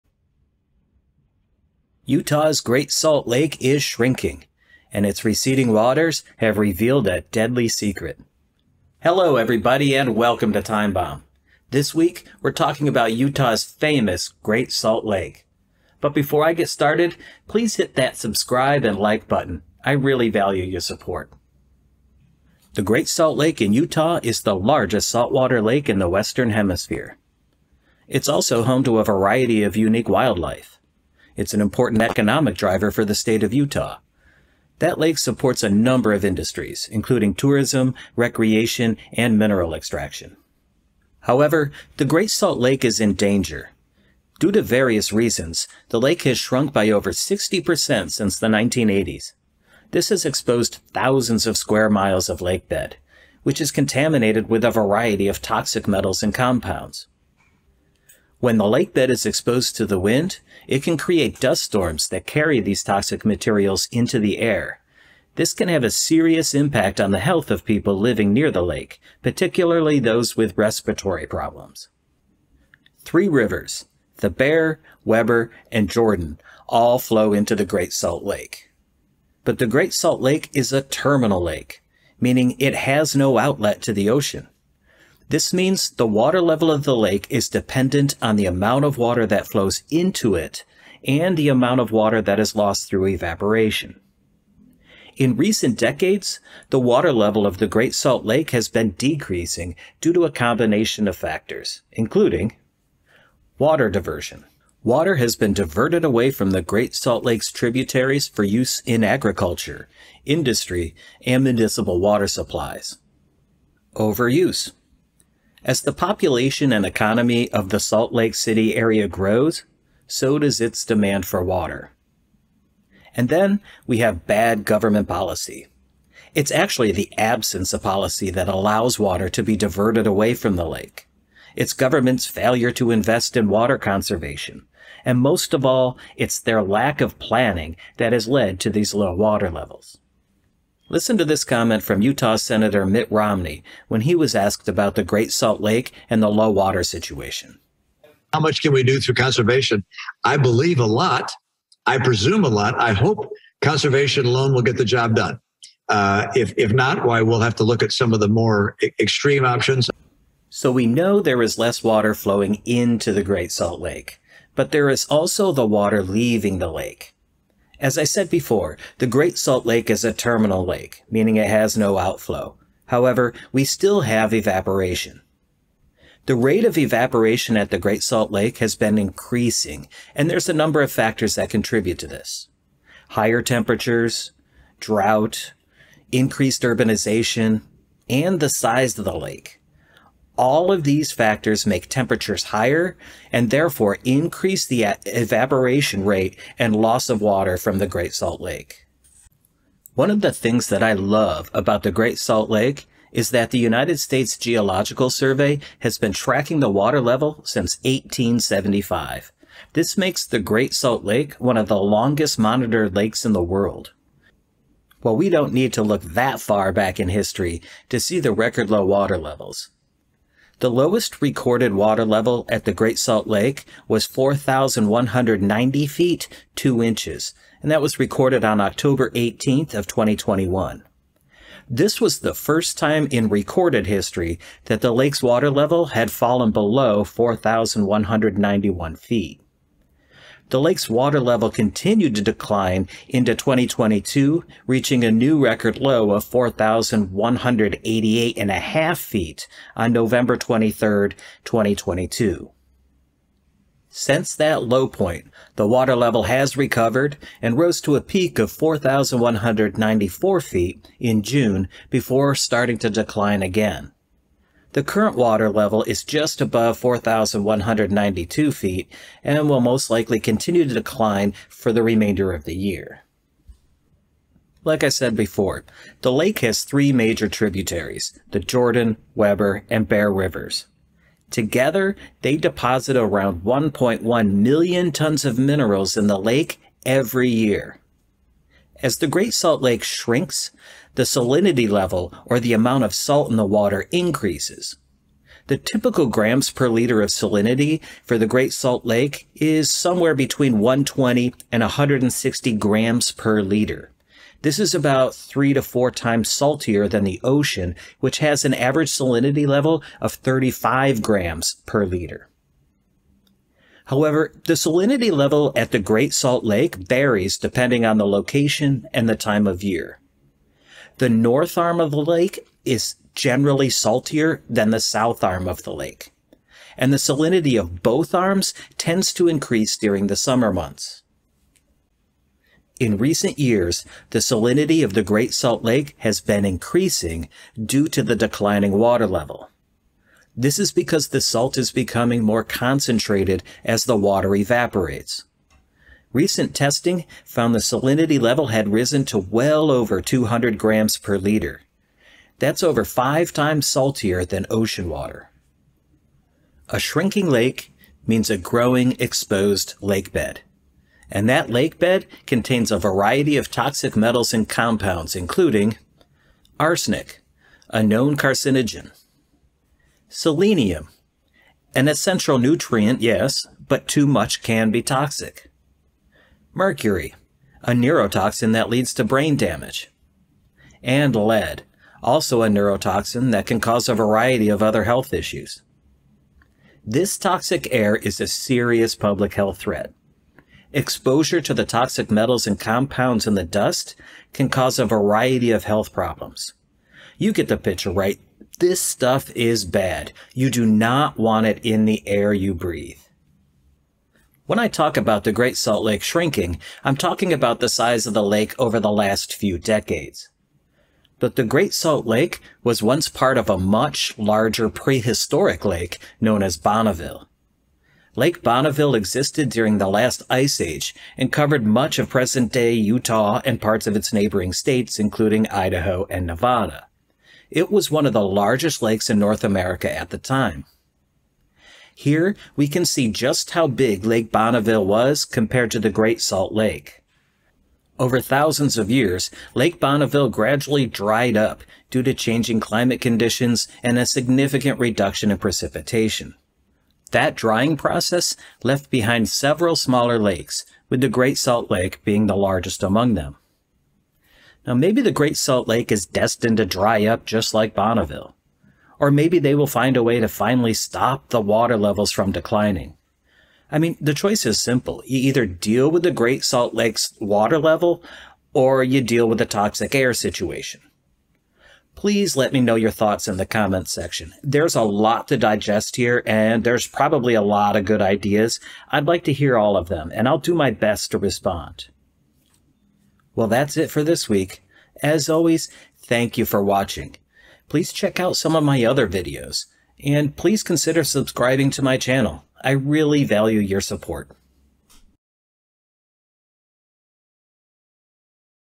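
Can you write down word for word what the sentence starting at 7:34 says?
Now maybe the Great Salt Lake is destined to dry up just like Bonneville.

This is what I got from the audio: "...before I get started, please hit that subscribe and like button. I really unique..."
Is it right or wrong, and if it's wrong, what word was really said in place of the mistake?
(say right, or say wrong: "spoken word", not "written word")
wrong: "value", not "unique".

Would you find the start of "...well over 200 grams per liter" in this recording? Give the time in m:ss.
5:49.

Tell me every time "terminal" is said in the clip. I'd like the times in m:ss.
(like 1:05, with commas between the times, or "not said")
1:20, 2:50.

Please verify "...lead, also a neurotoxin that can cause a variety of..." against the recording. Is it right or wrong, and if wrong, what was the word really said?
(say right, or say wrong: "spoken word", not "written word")
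right.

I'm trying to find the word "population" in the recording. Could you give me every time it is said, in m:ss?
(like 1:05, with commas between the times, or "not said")
1:55.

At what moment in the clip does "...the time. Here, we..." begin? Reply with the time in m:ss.
7:10.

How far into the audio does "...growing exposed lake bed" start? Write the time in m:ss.
5:58.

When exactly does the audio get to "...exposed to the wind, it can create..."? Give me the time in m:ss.
0:59.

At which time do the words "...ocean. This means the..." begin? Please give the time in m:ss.
1:24.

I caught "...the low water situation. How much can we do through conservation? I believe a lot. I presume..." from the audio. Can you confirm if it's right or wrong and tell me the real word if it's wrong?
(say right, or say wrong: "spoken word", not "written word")
right.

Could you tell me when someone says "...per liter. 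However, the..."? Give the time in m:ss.
5:11.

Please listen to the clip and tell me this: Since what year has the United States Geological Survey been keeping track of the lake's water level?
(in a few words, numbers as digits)
1875.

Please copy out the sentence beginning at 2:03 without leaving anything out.
And then we have bad government policy.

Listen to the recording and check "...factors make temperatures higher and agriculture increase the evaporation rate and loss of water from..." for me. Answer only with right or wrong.
wrong.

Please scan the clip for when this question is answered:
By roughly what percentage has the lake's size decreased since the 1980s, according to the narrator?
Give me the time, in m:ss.
0:46.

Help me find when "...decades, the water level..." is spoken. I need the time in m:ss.
1:35.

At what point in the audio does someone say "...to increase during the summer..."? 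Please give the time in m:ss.
5:29.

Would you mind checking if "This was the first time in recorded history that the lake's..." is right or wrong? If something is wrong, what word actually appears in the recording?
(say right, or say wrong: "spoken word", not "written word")
right.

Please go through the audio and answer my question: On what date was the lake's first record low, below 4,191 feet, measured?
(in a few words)
October 18th, 2021.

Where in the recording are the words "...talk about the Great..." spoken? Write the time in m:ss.
6:44.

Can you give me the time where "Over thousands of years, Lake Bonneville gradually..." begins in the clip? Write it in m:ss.
7:17.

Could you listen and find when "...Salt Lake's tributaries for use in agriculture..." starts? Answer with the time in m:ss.
1:46.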